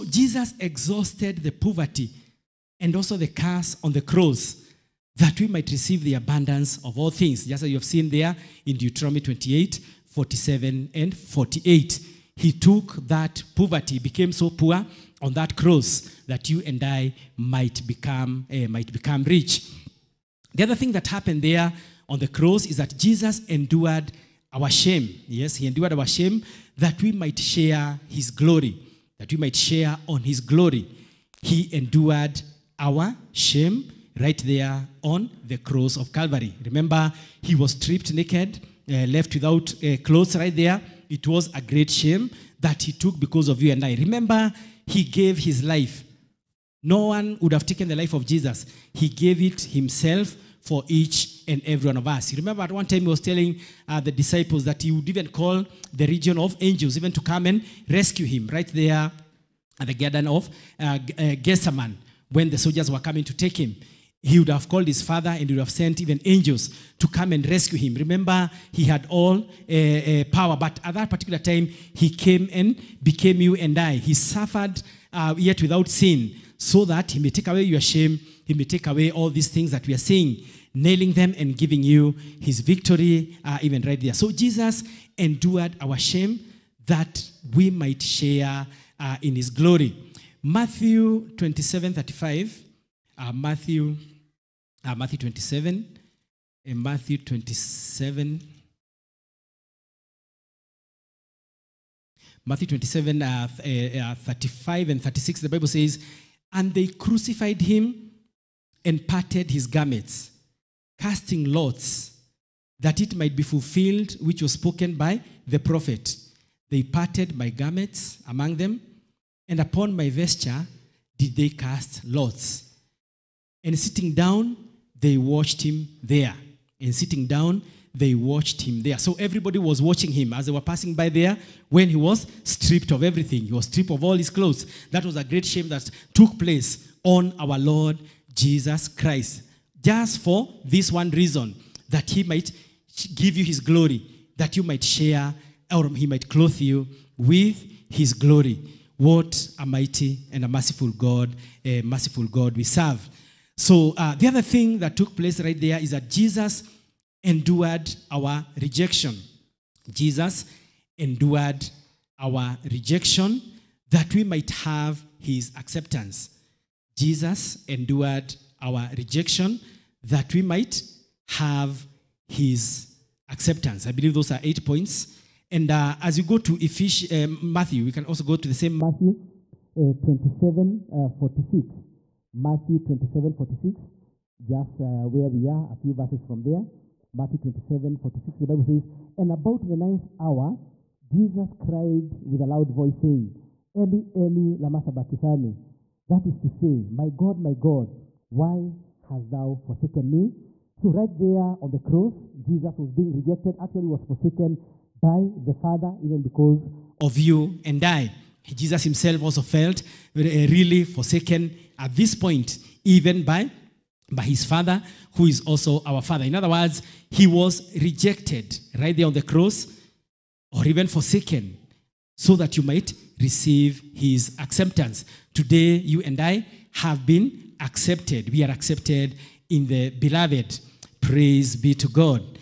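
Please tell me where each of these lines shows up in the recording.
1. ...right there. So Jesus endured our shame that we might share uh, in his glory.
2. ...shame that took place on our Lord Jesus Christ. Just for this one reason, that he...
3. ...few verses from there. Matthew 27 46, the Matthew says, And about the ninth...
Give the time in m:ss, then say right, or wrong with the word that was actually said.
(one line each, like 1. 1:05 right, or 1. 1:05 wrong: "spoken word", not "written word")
1. 1:23 right
2. 2:15 right
3. 3:05 wrong: "Bible", not "Matthew".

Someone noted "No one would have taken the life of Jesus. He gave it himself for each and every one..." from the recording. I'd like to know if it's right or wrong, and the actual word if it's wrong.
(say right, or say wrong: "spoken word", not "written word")
right.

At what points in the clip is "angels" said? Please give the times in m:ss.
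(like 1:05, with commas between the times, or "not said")
0:56, 1:06.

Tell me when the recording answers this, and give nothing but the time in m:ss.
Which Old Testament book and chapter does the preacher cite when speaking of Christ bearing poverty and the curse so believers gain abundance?
0:08.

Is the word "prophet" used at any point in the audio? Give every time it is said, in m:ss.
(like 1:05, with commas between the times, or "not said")
1:55.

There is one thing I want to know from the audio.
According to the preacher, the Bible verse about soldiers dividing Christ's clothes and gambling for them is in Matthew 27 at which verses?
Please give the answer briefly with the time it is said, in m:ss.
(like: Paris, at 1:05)
35 and 36, at 1:44.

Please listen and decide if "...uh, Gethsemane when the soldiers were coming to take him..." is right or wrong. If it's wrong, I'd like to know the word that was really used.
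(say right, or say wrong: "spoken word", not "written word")
right.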